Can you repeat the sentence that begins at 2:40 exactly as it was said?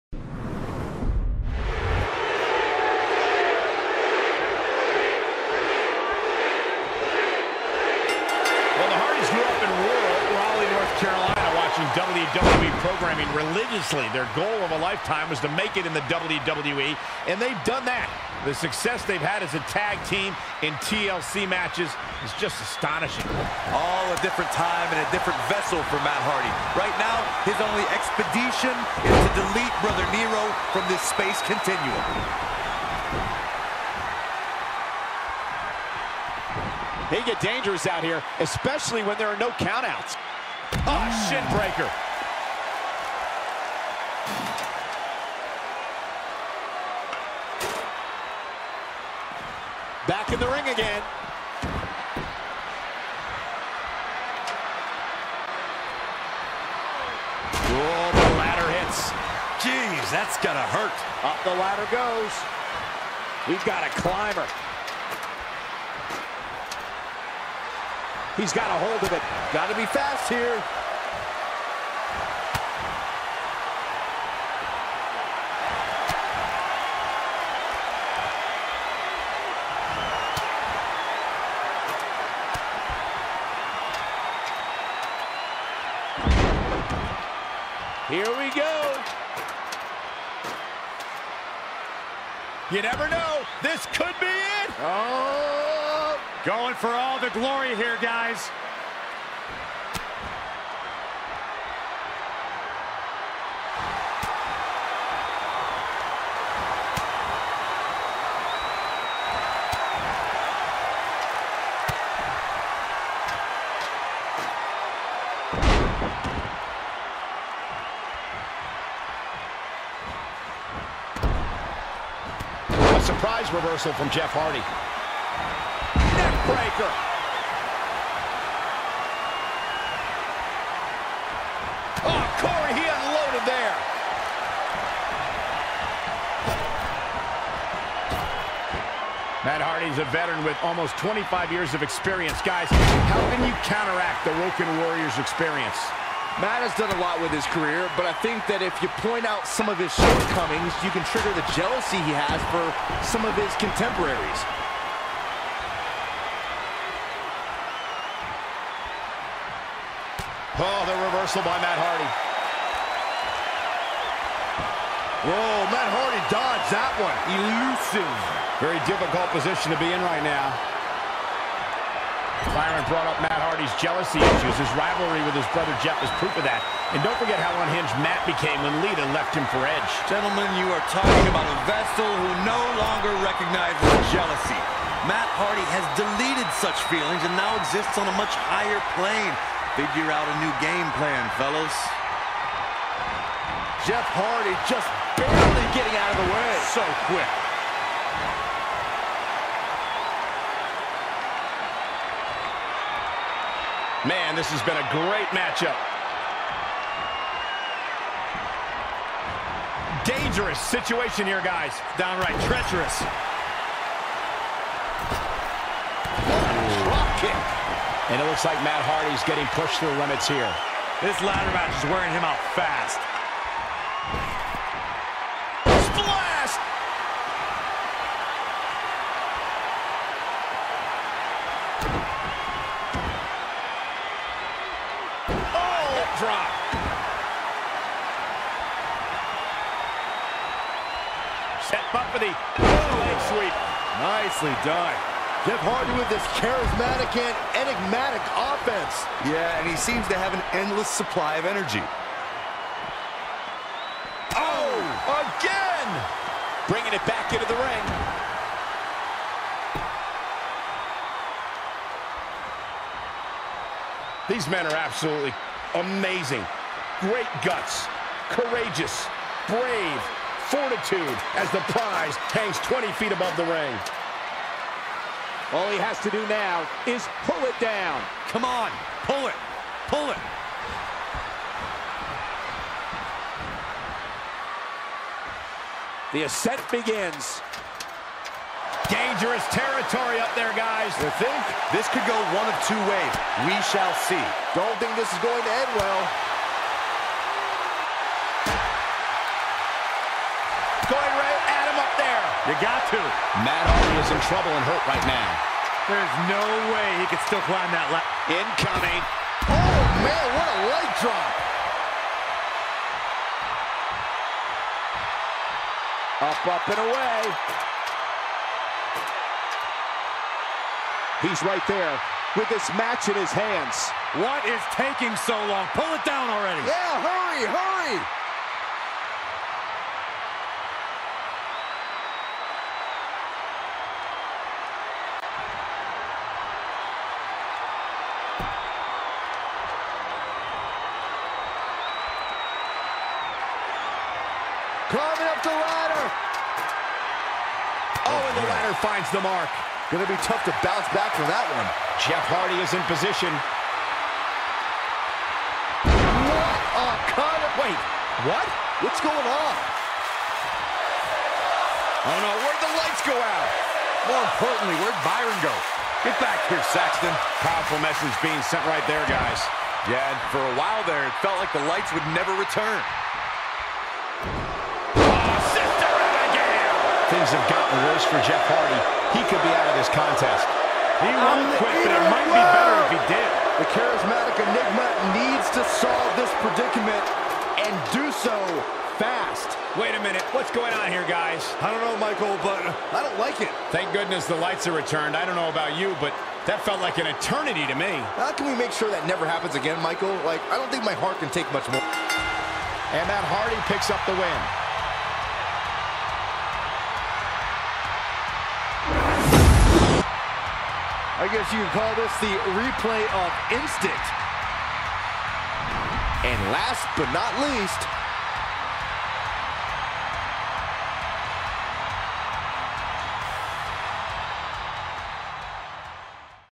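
Oh, the reversal by Matt Hardy.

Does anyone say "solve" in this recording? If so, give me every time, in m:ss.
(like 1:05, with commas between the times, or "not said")
6:25.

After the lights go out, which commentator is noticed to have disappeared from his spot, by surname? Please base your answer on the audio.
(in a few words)
Saxton.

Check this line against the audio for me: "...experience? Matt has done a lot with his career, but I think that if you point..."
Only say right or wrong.
right.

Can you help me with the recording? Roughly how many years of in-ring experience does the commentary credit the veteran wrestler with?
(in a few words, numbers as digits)
25.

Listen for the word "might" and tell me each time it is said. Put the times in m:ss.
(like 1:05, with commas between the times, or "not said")
6:22.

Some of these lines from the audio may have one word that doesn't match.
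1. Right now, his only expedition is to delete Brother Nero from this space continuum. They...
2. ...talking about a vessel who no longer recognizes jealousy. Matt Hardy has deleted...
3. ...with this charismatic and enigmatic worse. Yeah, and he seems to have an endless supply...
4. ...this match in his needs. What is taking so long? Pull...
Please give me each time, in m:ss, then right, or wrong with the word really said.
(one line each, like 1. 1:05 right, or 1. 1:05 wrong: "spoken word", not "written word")
1. 0:26 right
2. 3:00 right
3. 4:05 wrong: "offense", not "worse"
4. 5:22 wrong: "hands", not "needs".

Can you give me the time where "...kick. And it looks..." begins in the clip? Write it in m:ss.
3:37.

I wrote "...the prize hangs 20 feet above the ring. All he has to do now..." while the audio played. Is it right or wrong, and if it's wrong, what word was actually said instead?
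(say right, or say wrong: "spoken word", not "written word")
right.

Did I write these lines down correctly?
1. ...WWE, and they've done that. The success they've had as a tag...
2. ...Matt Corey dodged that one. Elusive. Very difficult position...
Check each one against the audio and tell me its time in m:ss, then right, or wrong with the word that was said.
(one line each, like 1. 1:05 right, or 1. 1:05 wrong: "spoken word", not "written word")
1. 0:16 right
2. 2:45 wrong: "Hardy", not "Corey".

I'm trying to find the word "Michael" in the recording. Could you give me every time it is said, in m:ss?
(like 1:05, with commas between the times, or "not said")
6:31, 6:39.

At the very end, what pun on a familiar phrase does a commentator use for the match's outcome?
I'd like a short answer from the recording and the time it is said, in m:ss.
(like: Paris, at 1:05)
replay of instinct, at 6:52.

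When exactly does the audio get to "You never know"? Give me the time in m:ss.
1:32.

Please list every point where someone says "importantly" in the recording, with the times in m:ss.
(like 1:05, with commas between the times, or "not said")
6:04.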